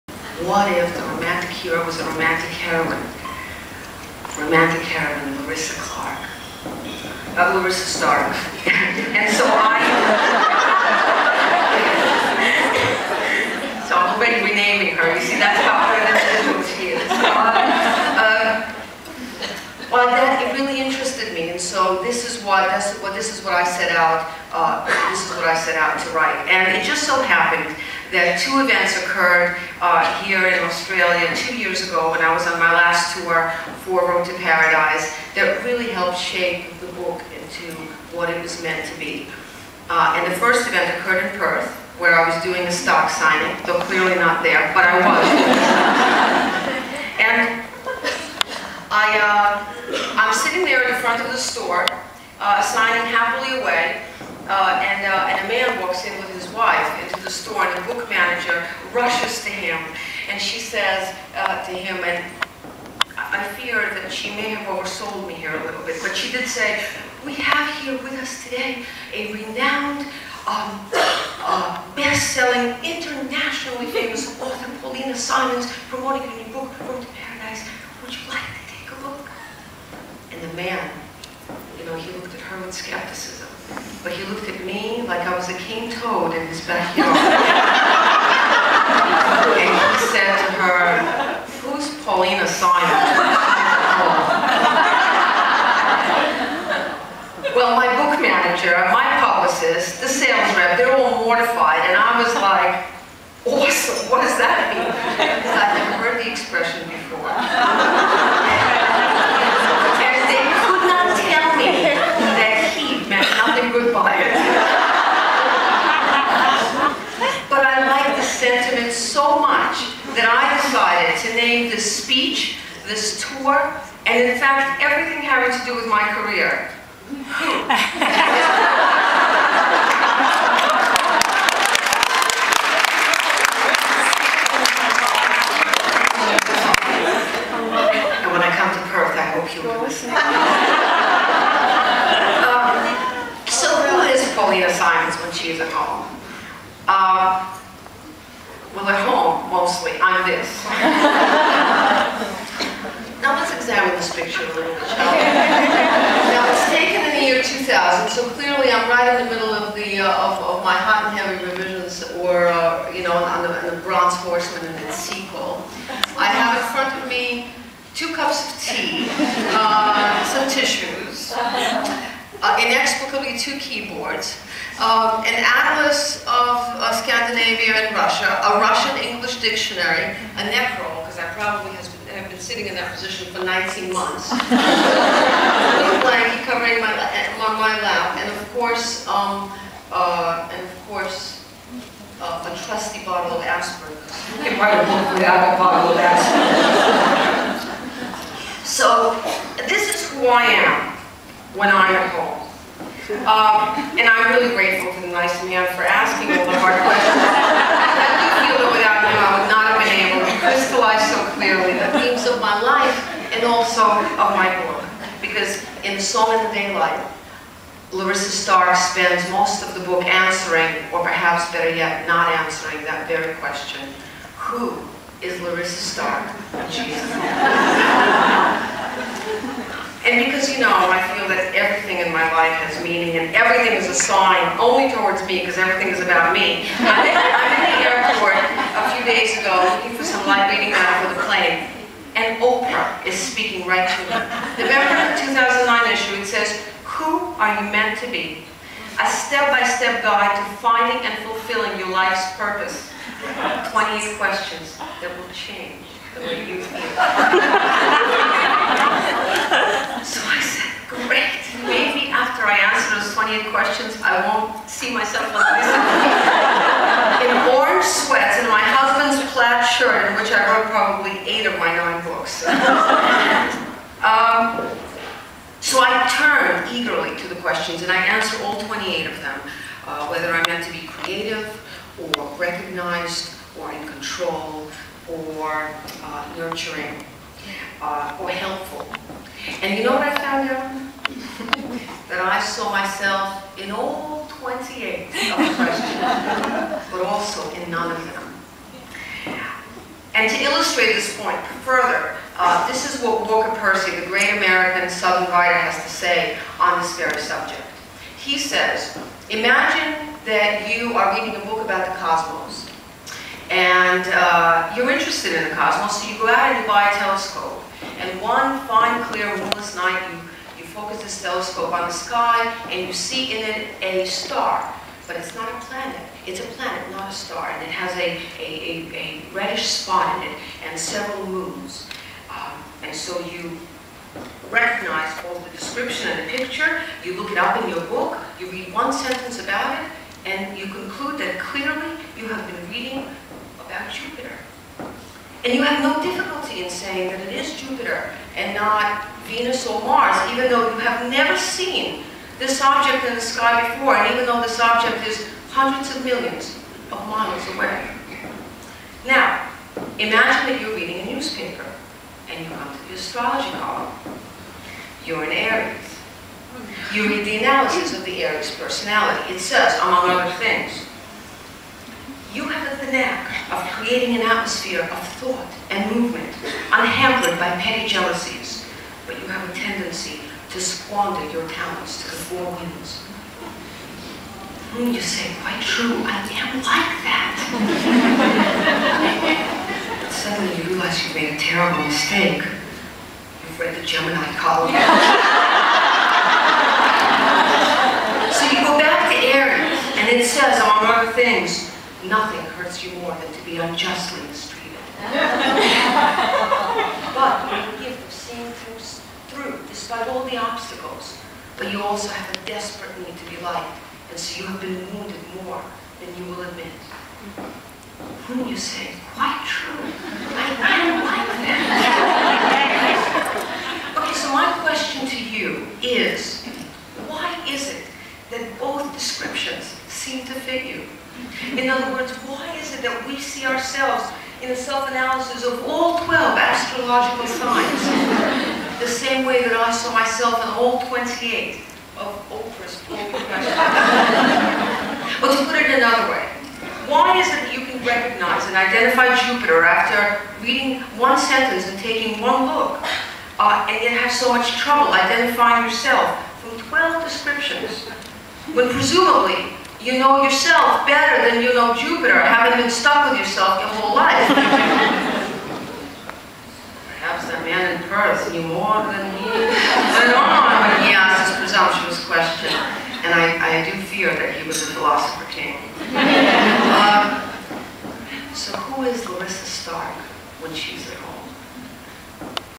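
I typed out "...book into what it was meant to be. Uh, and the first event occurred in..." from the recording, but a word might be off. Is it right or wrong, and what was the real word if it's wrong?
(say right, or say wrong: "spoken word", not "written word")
right.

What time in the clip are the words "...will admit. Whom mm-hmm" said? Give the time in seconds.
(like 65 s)
416 s.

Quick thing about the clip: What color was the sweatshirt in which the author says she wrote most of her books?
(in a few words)
Orange.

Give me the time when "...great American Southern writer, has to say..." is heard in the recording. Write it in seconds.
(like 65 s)
304 s.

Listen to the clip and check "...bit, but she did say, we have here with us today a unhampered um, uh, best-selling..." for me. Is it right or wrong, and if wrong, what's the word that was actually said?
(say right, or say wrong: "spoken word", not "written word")
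wrong: "renowned", not "unhampered".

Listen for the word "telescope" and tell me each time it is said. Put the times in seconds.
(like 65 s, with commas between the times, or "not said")
316 s, 321 s.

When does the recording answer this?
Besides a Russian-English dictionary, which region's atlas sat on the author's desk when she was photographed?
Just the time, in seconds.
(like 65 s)
177 s.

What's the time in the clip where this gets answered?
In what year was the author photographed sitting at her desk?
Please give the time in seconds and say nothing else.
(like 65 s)
157 s.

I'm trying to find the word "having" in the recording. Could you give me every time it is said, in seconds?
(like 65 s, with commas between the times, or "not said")
125 s, 462 s.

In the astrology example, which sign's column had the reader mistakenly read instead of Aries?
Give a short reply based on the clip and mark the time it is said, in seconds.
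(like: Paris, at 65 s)
Gemini, at 393 s.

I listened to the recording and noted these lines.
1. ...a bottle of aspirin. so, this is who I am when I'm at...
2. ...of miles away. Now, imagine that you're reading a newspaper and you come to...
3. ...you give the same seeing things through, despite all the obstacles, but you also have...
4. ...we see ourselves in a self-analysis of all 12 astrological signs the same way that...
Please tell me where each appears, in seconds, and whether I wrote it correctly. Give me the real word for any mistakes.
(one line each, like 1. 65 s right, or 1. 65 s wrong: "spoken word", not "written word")
1. 195 s right
2. 356 s right
3. 407 s right
4. 433 s right.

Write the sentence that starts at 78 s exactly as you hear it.
Would you like to take a look?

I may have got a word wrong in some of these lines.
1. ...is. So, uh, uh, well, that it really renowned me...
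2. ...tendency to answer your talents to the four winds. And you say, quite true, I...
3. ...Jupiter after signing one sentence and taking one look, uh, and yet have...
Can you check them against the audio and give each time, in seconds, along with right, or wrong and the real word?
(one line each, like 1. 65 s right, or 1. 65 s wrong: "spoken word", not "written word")
1. 16 s wrong: "interested", not "renowned"
2. 379 s wrong: "squander", not "answer"
3. 449 s wrong: "reading", not "signing".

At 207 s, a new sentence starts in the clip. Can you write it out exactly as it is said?
I do feel that without him, I would not have been able to crystallize so and also of my book.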